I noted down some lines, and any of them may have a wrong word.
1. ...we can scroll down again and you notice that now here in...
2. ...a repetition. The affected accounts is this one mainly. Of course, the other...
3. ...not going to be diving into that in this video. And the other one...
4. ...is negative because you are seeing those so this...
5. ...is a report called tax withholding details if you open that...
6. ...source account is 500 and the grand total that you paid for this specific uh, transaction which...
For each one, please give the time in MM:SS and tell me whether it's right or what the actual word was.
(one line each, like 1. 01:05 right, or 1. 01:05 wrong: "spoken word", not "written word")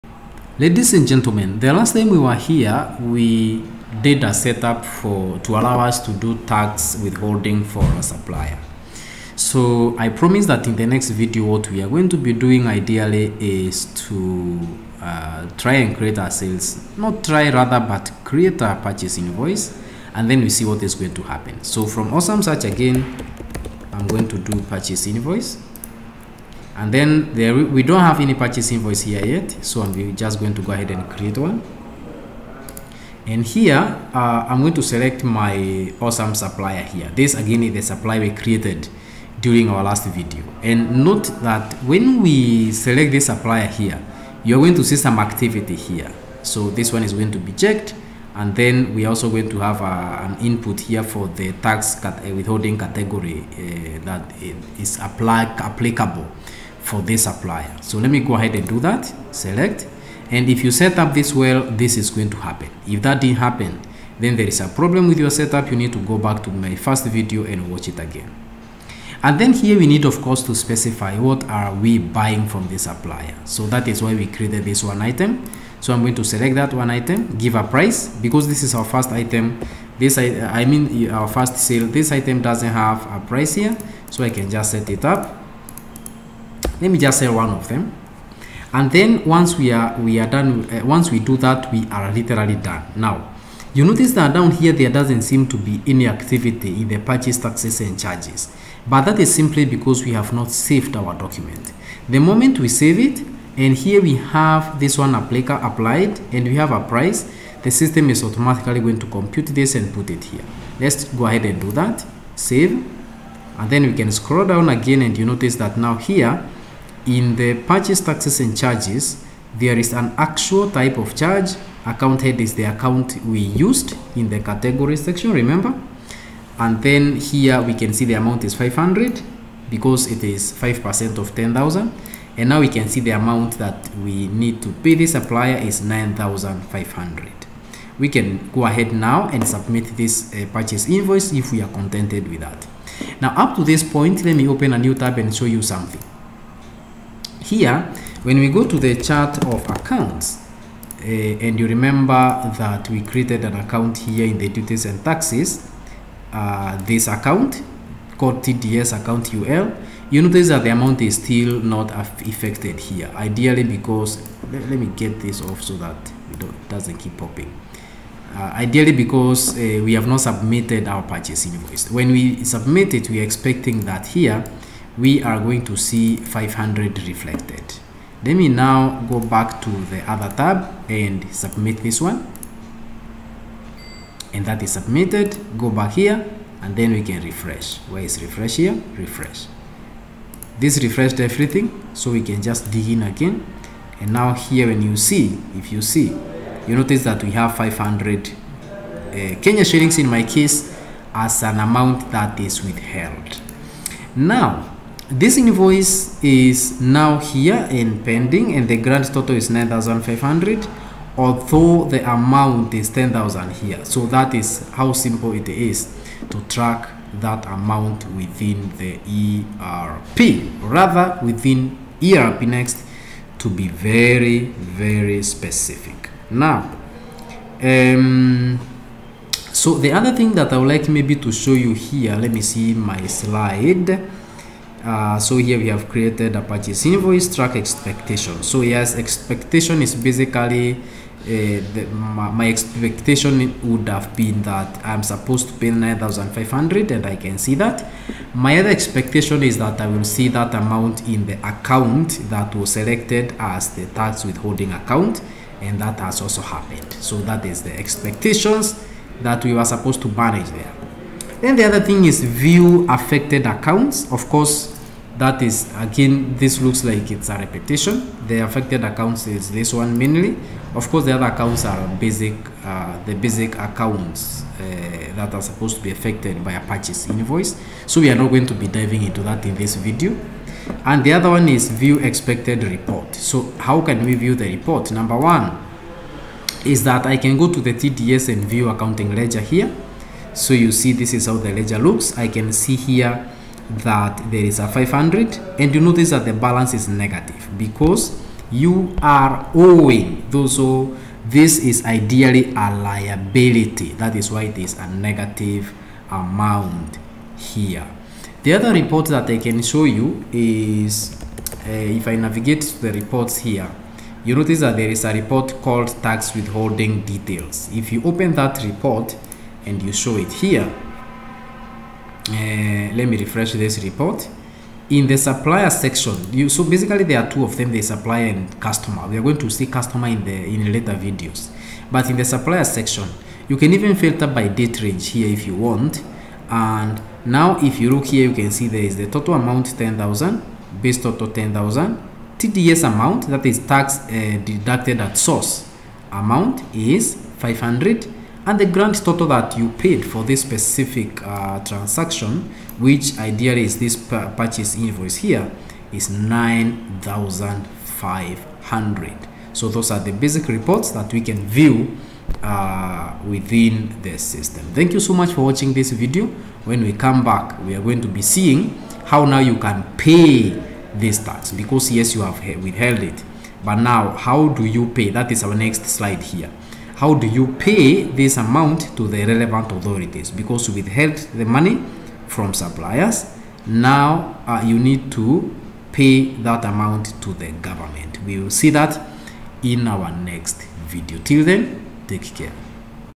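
1. 01:53 right
2. 04:27 right
3. 04:38 right
4. 04:56 wrong: "owing", not "seeing"
5. 05:14 right
6. 05:45 wrong: "amount", not "account".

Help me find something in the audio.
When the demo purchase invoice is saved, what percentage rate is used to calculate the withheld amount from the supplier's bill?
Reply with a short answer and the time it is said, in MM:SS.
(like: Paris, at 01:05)
5%, at 02:10.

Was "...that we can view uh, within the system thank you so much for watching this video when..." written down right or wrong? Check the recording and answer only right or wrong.
right.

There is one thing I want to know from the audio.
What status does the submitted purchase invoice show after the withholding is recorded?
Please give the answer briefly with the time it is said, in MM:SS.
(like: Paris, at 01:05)
Pending, at 03:28.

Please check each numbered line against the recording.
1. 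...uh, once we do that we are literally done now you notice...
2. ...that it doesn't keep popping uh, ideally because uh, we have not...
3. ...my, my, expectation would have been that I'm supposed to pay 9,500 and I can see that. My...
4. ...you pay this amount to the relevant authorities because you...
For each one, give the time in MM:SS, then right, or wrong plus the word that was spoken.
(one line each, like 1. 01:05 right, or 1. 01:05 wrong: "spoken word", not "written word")
1. 01:30 right
2. 02:45 right
3. 04:01 right
4. 06:17 right.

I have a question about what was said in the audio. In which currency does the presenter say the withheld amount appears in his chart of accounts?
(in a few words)
Kenya shillings.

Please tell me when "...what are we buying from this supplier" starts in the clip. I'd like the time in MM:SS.
01:11.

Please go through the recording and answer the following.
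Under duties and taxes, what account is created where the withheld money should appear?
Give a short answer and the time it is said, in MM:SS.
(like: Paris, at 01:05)
TDS account UL, at 02:38.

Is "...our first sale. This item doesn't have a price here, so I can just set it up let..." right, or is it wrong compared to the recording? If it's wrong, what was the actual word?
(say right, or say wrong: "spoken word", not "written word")
right.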